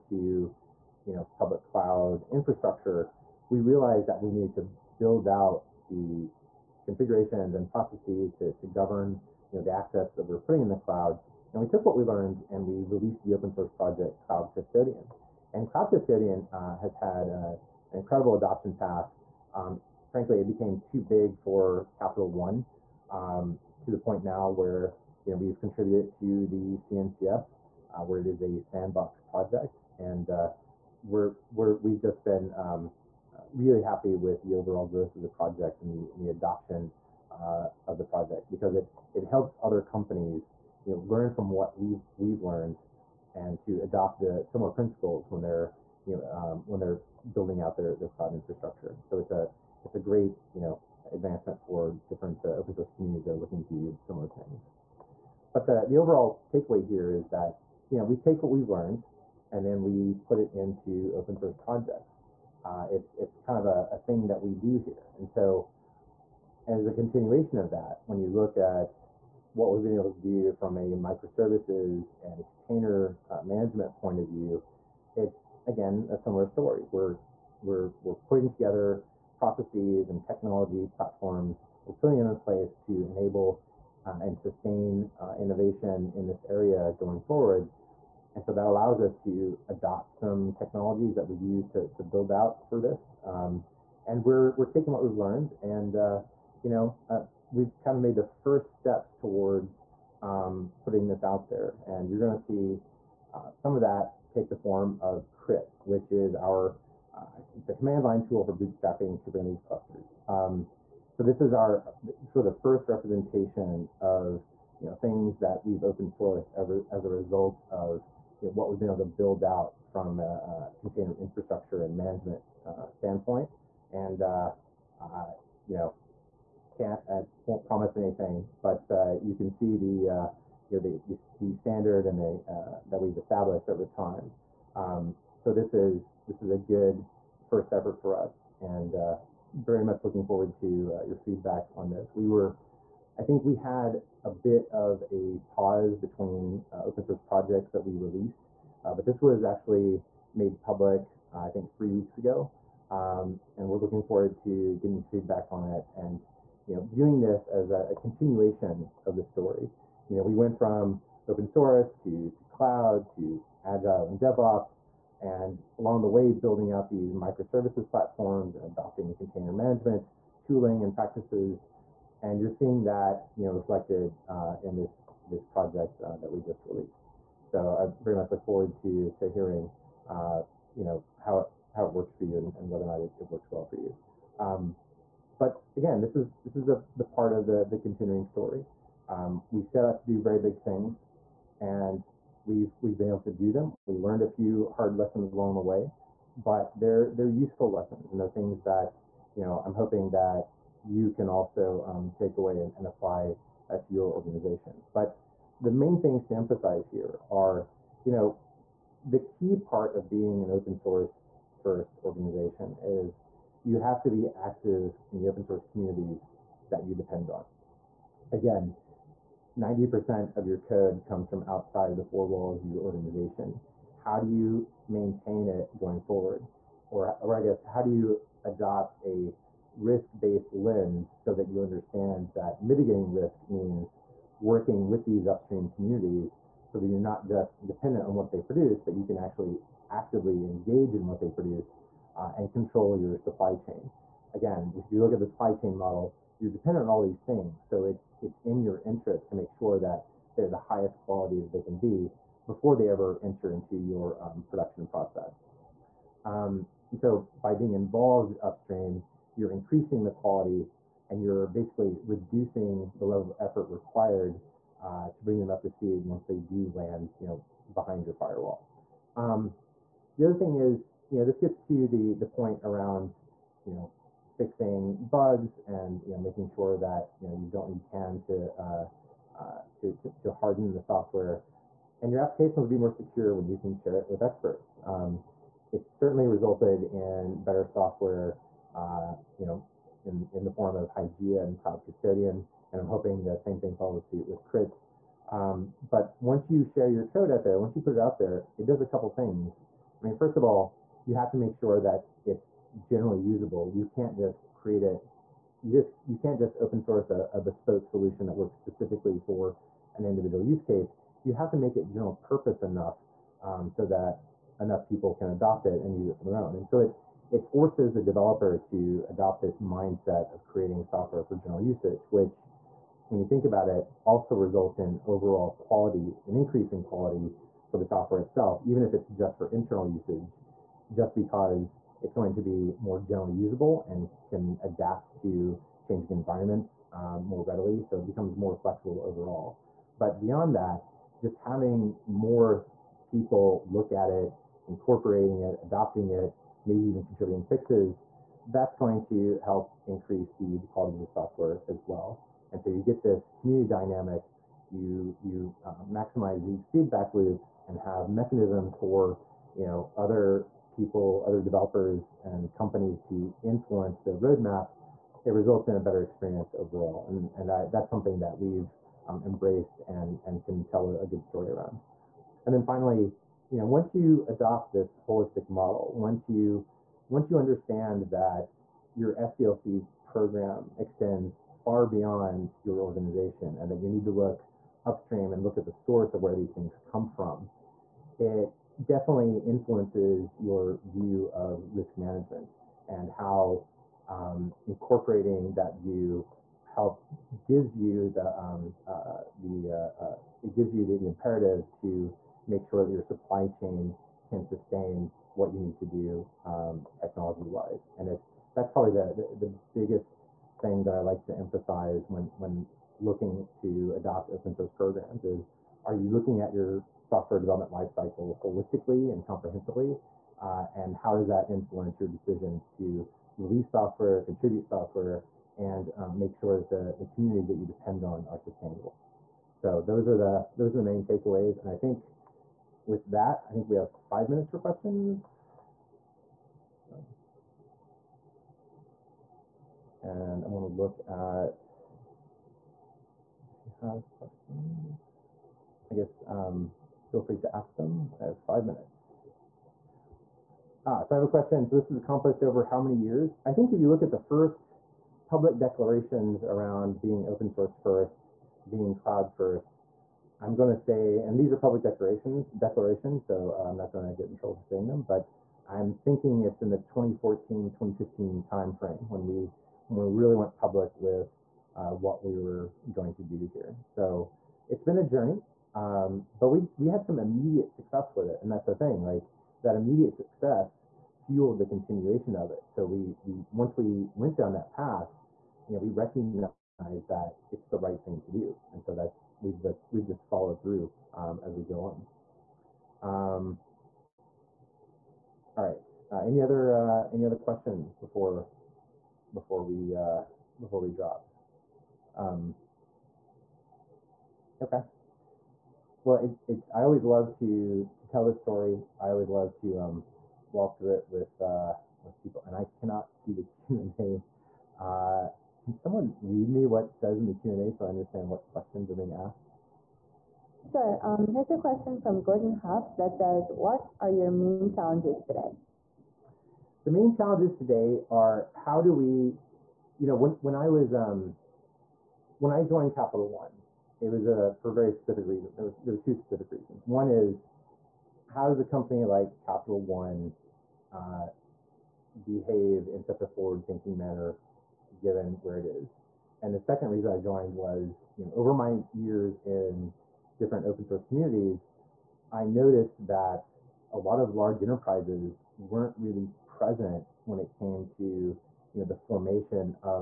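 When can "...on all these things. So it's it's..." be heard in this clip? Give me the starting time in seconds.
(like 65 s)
246 s.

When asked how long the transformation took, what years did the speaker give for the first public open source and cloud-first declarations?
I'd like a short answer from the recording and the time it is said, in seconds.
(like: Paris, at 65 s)
2014-2015, at 466 s.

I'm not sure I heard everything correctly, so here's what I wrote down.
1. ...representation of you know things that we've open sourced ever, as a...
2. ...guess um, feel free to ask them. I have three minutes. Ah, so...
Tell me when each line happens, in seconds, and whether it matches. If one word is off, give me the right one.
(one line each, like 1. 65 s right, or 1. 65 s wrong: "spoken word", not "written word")
1. 112 s right
2. 445 s wrong: "five", not "three".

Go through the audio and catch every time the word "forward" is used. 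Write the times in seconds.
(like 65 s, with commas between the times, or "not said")
87 s, 140 s, 154 s, 178 s, 226 s, 543 s.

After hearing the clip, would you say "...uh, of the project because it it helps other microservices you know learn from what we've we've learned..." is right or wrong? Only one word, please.
wrong.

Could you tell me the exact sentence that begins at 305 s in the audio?
You just you can't just open source a, a bespoke solution that works specifically for an individual use case.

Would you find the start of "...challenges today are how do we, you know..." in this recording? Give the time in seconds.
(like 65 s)
527 s.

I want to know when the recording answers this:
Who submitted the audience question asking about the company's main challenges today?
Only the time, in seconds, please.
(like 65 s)
522 s.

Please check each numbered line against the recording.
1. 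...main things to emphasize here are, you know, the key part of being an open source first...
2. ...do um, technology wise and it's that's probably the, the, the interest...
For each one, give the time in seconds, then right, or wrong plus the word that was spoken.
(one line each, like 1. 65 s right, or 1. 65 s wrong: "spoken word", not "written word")
1. 205 s right
2. 405 s wrong: "biggest", not "interest".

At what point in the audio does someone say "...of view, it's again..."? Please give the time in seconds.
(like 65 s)
74 s.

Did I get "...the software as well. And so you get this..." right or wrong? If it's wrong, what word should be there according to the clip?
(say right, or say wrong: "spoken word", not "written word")
right.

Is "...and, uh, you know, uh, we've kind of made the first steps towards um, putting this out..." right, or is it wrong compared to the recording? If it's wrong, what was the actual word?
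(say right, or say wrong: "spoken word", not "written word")
right.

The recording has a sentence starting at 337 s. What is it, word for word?
So it becomes more flexible overall.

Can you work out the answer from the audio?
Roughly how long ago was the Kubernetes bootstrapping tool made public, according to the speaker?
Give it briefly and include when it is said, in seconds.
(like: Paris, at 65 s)
3 weeks ago, at 151 s.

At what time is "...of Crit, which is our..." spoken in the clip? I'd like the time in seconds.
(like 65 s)
105 s.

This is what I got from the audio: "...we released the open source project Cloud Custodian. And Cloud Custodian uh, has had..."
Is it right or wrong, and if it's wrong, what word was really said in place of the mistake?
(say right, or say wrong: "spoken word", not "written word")
right.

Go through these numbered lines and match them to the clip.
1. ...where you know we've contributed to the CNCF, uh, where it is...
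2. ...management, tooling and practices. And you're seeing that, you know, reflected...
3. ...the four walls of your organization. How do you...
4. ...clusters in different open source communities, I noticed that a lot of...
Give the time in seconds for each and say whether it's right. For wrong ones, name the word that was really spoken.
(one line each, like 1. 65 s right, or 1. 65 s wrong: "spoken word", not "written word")
1. 24 s right
2. 169 s right
3. 221 s right
4. 548 s wrong: "years", not "clusters".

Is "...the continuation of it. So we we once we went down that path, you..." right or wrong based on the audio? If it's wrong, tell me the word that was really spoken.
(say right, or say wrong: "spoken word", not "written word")
right.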